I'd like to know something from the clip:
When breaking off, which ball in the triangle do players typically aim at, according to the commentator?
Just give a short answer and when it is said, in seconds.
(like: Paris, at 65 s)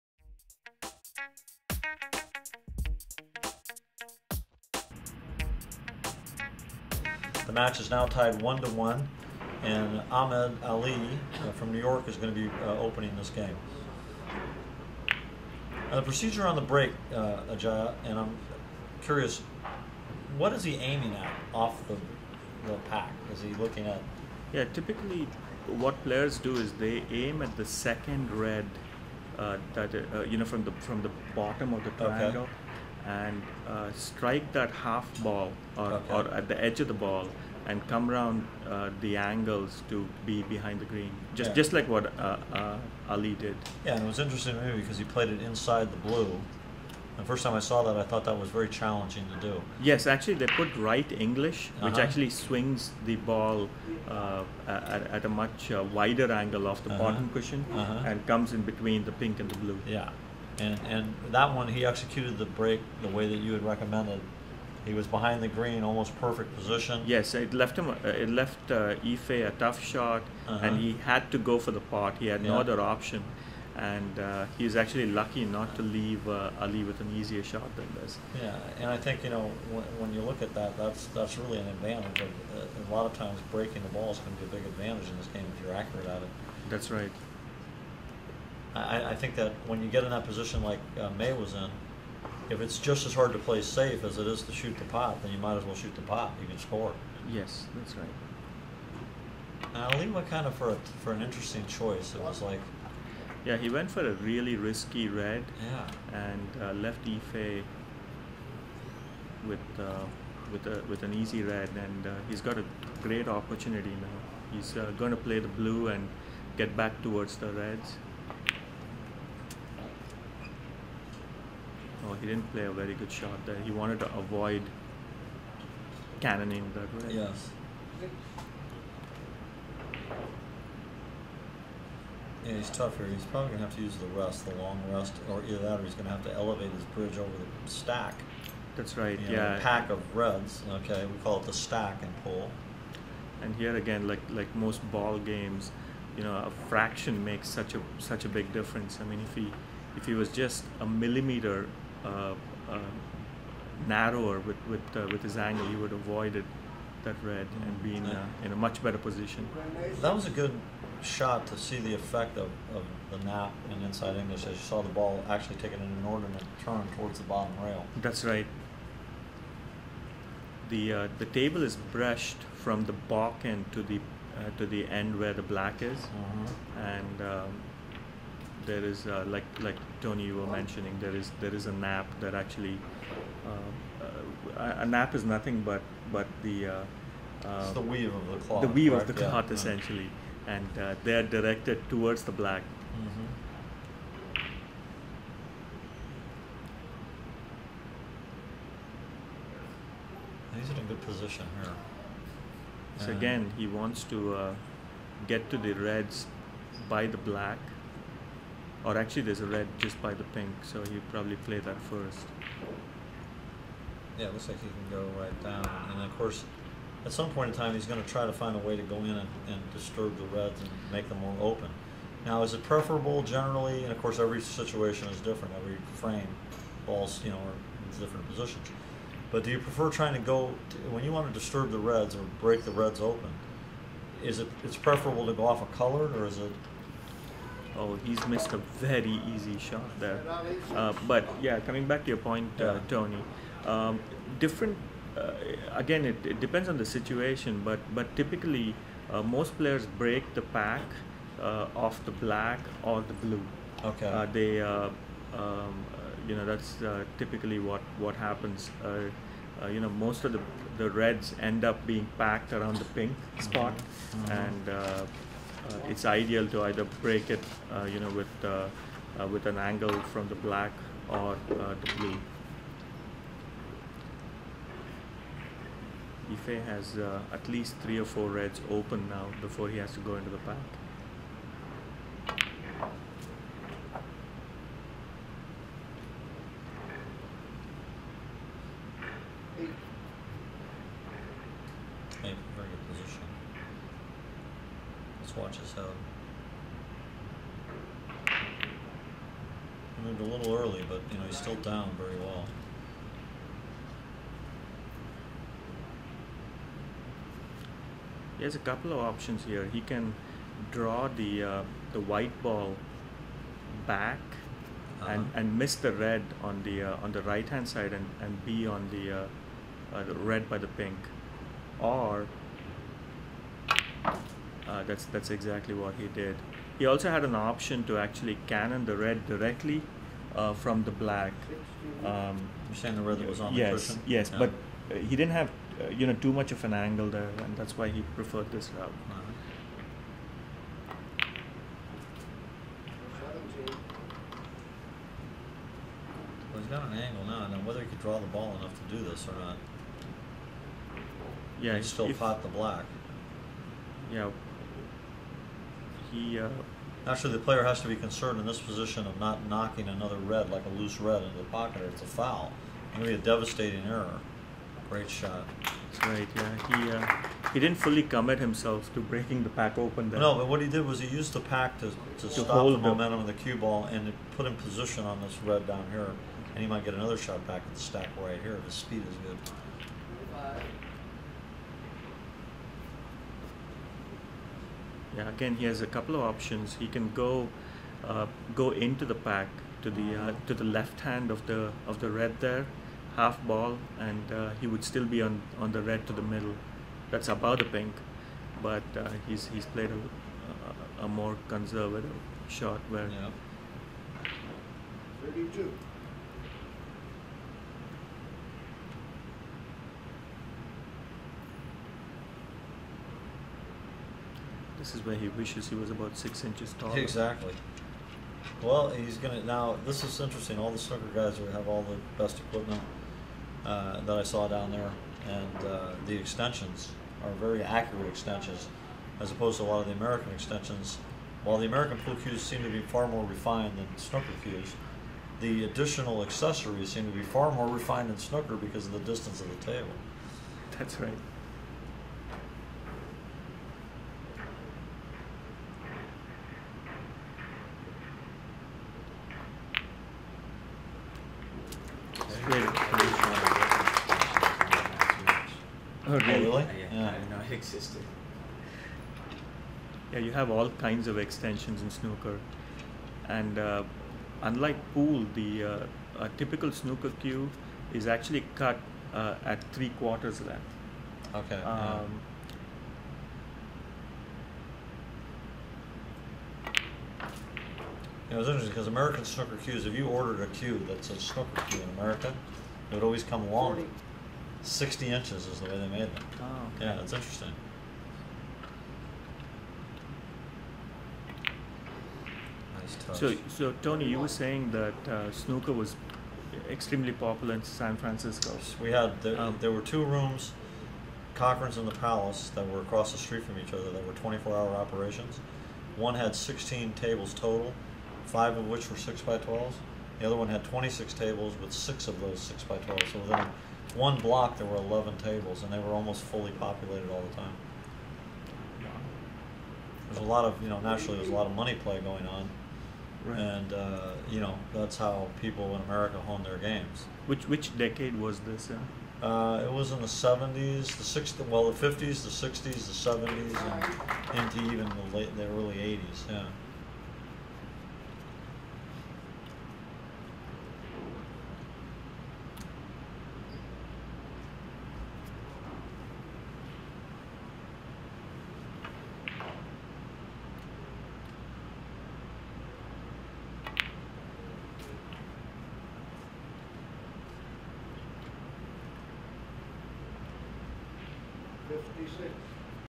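The second red, at 27 s.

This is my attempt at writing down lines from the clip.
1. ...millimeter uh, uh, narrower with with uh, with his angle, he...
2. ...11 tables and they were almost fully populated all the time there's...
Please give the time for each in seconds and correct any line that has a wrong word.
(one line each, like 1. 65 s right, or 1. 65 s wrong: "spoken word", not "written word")
1. 150 s right
2. 514 s right.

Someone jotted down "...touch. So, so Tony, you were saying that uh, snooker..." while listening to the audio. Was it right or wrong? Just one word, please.
right.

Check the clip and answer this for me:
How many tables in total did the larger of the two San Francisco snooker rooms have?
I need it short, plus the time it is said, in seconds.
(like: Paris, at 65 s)
26, at 510 s.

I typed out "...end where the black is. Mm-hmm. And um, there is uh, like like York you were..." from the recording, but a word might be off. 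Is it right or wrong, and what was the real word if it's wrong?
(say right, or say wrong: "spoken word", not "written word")
wrong: "Tony", not "York".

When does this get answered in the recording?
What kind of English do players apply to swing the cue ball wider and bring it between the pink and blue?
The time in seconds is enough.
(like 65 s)
50 s.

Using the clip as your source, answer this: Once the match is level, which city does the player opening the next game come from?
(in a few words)
New York.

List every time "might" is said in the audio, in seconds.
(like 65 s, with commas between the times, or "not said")
95 s, 376 s.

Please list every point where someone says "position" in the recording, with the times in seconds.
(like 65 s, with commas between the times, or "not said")
66 s, 90 s, 158 s, 201 s, 228 s, 358 s, 374 s.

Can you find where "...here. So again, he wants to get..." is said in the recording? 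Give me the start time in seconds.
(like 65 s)
201 s.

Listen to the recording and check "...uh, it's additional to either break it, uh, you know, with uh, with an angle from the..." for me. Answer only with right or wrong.
wrong.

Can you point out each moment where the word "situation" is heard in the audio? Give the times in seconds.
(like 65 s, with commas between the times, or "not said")
224 s, 246 s.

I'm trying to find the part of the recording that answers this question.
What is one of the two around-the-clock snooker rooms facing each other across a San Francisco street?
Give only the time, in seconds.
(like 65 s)
501 s.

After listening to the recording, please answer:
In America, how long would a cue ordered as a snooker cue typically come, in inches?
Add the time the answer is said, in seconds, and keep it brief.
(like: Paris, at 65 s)
60 inches, at 484 s.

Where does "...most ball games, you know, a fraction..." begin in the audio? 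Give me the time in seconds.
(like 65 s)
144 s.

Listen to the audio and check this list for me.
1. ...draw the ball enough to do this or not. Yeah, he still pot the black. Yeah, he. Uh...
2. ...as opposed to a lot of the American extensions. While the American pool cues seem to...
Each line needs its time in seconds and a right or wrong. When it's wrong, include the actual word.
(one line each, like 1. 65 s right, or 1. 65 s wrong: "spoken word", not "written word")
1. 348 s right
2. 429 s right.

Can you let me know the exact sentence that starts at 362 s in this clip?
It's going to be a devastating error.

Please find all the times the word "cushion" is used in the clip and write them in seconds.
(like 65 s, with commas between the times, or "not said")
57 s, 333 s.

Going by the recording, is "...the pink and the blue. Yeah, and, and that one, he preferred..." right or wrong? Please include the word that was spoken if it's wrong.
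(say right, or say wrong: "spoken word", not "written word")
wrong: "executed", not "preferred".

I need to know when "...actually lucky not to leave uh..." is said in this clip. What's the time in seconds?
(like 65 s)
74 s.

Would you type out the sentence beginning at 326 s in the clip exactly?
He also had an option to actually cannon the red directly uh, from the black.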